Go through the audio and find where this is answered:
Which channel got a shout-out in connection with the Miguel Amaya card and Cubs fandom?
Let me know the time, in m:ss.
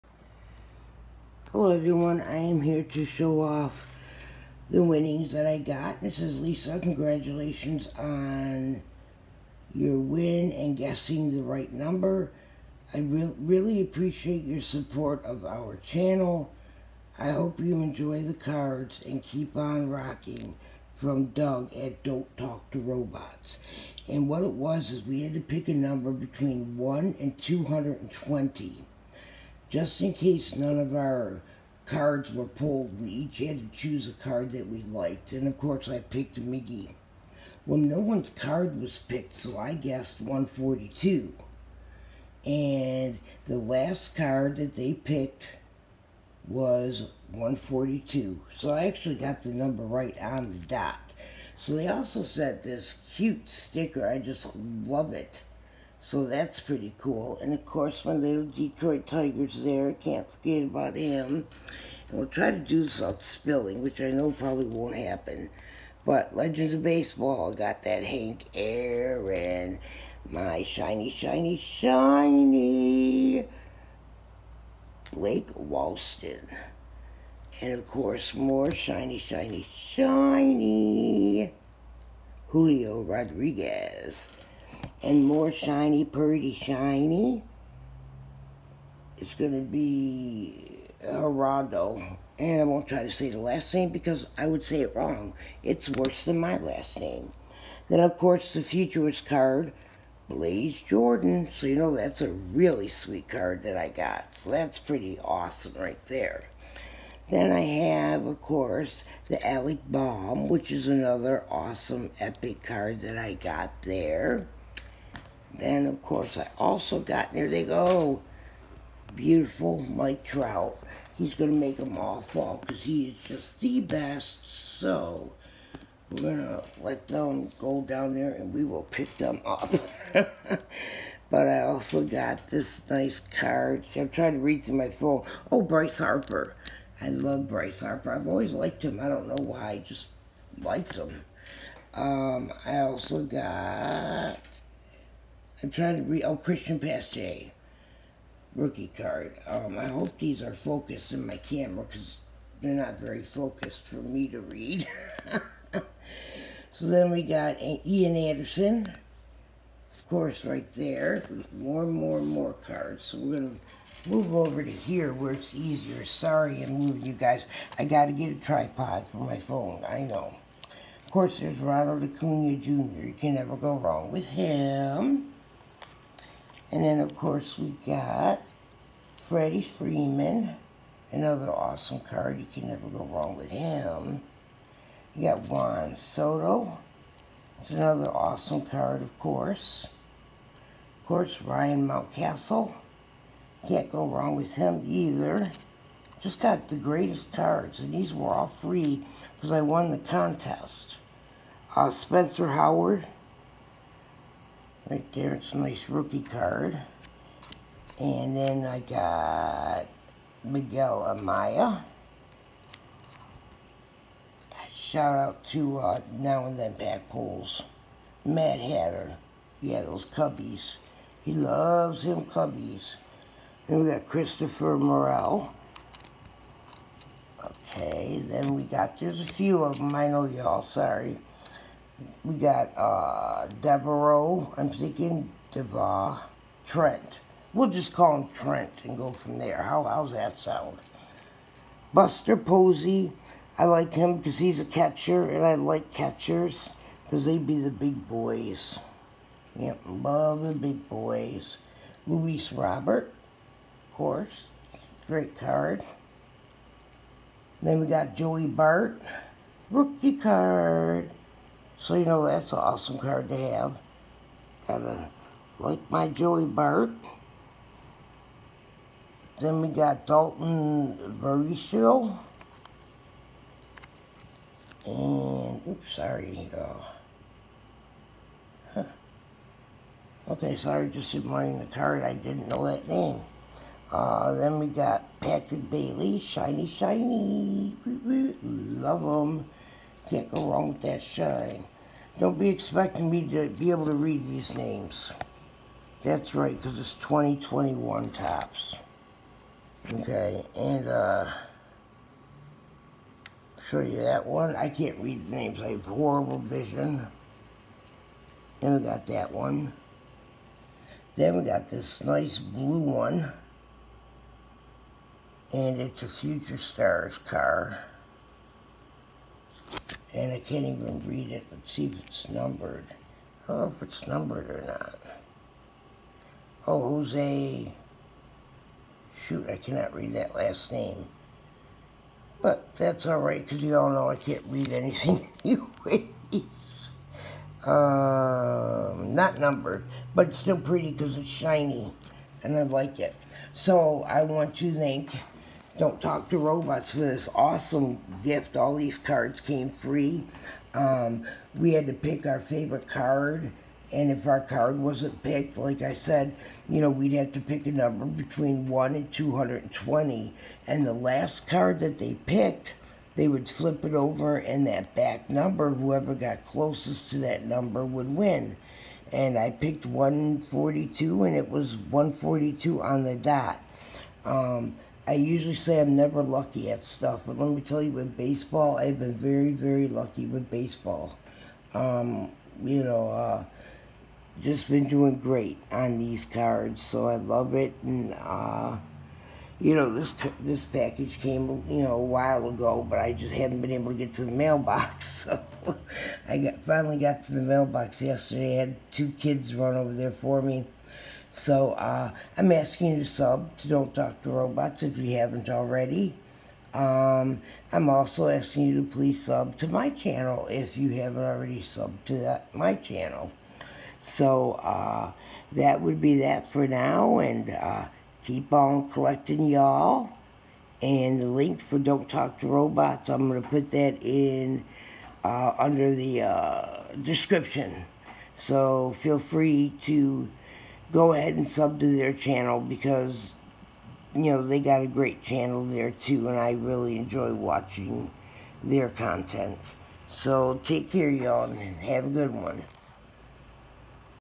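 3:36.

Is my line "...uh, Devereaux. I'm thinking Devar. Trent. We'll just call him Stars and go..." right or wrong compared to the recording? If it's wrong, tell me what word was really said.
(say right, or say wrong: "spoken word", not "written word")
wrong: "Trent", not "Stars".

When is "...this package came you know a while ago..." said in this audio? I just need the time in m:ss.
6:30.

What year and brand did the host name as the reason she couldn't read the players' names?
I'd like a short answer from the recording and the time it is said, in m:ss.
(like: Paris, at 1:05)
2021 Topps, at 4:56.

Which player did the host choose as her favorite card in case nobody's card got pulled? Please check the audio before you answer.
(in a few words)
Miggy.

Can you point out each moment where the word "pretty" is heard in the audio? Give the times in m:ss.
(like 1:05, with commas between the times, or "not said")
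0:56, 1:26, 1:44, 5:40.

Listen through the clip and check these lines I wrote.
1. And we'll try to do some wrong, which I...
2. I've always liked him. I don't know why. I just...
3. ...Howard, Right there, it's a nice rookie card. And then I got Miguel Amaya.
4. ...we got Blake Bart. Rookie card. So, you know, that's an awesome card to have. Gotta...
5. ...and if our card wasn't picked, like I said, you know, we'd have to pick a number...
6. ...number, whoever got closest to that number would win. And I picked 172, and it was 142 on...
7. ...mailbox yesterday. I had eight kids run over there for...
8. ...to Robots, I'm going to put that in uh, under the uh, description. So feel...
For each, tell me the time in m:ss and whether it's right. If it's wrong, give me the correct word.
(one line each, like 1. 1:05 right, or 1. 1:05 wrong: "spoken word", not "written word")
1. 1:02 wrong: "spilling", not "wrong"
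2. 2:18 right
3. 3:22 right
4. 4:17 wrong: "Joey", not "Blake"
5. 5:53 right
6. 6:05 wrong: "142", not "172"
7. 6:37 wrong: "two", not "eight"
8. 7:02 right.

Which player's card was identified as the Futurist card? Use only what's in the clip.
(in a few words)
Blaze Jordan.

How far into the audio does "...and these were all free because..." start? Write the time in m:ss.
3:17.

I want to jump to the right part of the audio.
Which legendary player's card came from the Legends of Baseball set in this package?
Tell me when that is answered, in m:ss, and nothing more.
1:08.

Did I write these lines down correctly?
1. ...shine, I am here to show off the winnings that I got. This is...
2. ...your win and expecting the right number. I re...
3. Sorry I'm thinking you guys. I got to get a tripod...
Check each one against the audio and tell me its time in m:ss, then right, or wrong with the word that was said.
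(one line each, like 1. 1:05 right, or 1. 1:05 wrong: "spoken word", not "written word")
1. 0:01 wrong: "everyone", not "shine"
2. 0:09 wrong: "guessing", not "expecting"
3. 2:46 wrong: "moving", not "thinking".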